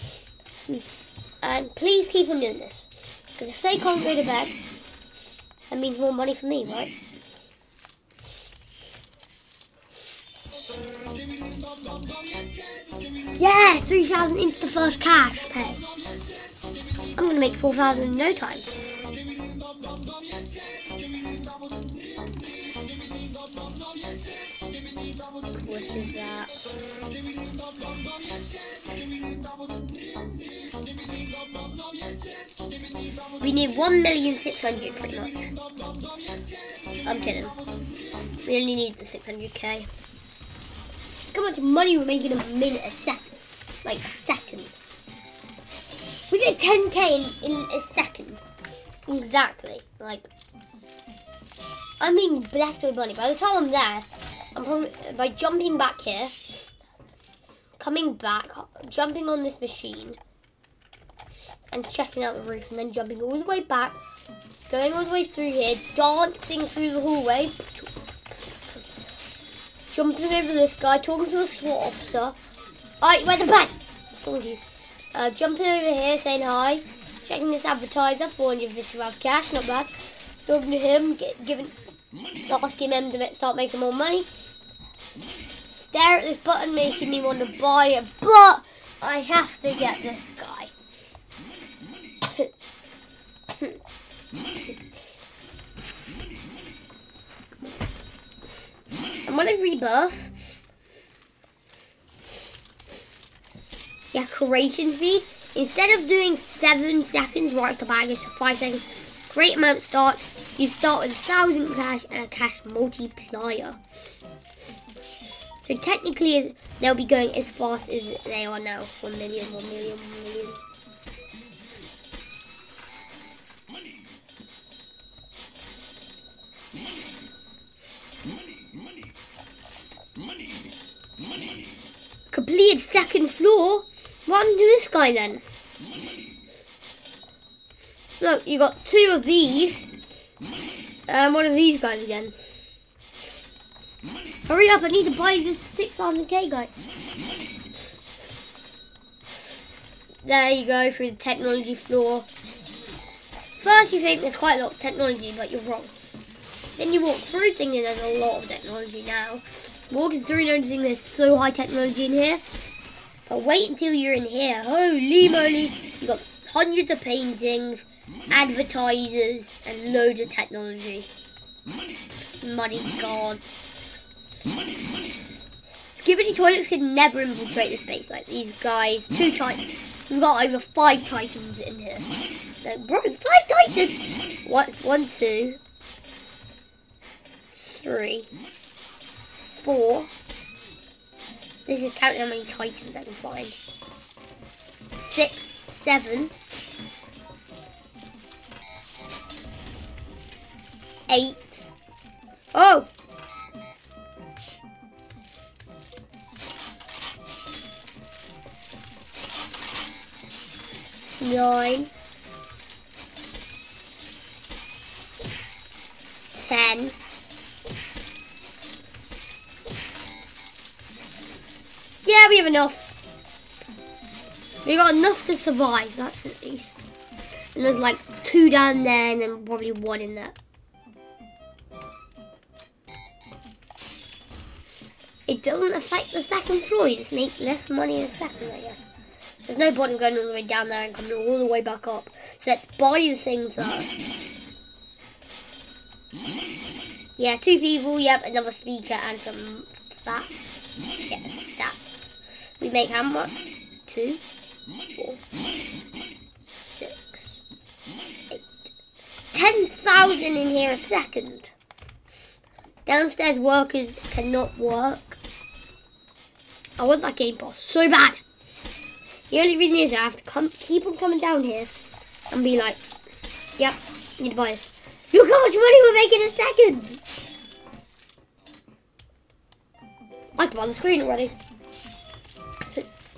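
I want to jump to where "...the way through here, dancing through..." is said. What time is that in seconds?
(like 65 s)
65 s.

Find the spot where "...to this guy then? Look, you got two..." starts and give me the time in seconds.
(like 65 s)
134 s.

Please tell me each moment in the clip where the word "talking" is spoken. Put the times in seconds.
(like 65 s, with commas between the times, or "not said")
70 s, 80 s.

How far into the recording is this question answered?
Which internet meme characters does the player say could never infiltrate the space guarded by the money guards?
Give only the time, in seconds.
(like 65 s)
175 s.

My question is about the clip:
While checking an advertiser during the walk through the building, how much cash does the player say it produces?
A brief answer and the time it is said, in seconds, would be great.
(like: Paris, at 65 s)
450, at 78 s.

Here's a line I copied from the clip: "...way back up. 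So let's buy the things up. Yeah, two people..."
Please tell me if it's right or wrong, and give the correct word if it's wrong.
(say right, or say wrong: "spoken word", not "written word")
right.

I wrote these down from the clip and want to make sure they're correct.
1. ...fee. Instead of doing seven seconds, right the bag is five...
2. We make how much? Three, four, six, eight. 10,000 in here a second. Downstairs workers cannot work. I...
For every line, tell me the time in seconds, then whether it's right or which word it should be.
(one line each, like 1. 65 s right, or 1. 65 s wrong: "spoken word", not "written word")
1. 104 s right
2. 252 s wrong: "Two", not "Three".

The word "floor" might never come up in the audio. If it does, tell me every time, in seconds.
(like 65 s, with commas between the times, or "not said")
133 s, 151 s, 236 s.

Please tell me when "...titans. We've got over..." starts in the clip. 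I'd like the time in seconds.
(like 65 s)
179 s.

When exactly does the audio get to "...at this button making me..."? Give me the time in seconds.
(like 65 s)
86 s.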